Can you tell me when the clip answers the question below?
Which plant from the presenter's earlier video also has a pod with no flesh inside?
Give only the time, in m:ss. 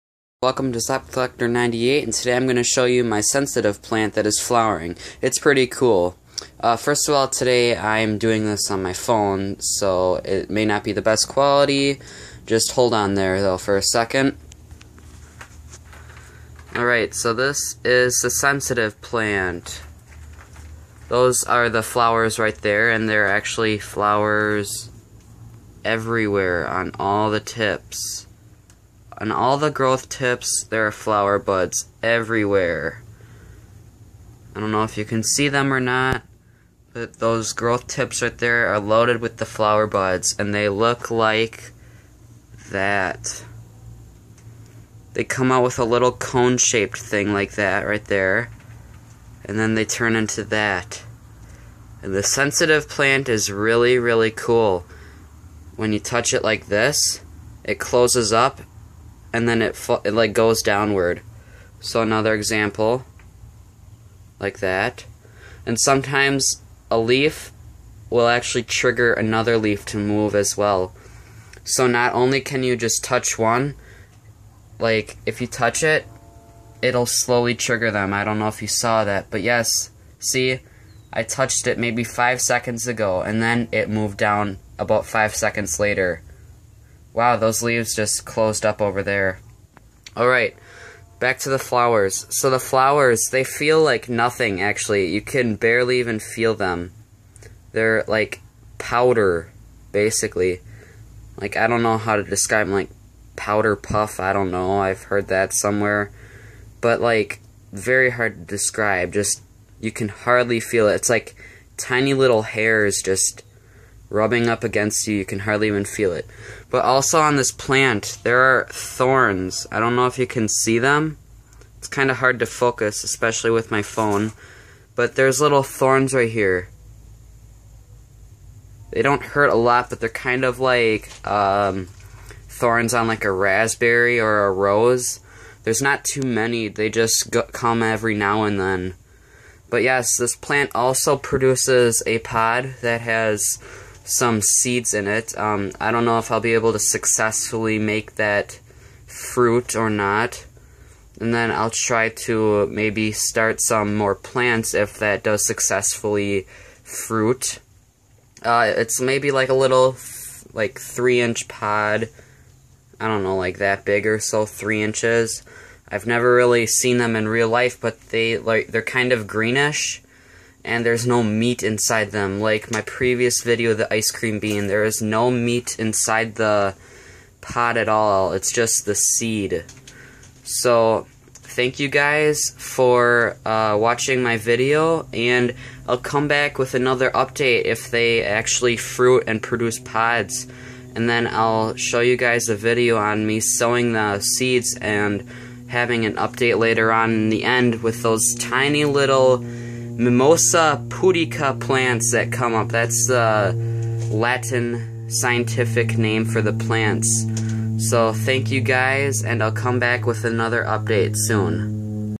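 2:53.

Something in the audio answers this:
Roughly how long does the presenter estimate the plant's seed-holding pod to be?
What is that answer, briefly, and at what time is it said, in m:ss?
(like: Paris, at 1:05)
3 inches, at 2:40.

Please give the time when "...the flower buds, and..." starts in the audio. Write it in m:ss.
0:39.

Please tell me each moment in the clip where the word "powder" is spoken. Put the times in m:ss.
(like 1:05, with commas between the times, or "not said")
1:38, 1:43.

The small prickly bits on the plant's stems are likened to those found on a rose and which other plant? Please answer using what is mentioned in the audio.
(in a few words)
raspberry.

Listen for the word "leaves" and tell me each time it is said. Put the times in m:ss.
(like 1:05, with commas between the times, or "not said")
1:27.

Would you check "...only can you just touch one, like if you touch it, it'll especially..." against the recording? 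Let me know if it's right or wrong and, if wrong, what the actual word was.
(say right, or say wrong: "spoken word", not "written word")
wrong: "slowly", not "especially".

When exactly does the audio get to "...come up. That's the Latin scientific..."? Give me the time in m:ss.
3:22.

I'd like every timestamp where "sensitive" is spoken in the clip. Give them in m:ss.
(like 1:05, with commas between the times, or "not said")
0:03, 0:18, 0:52.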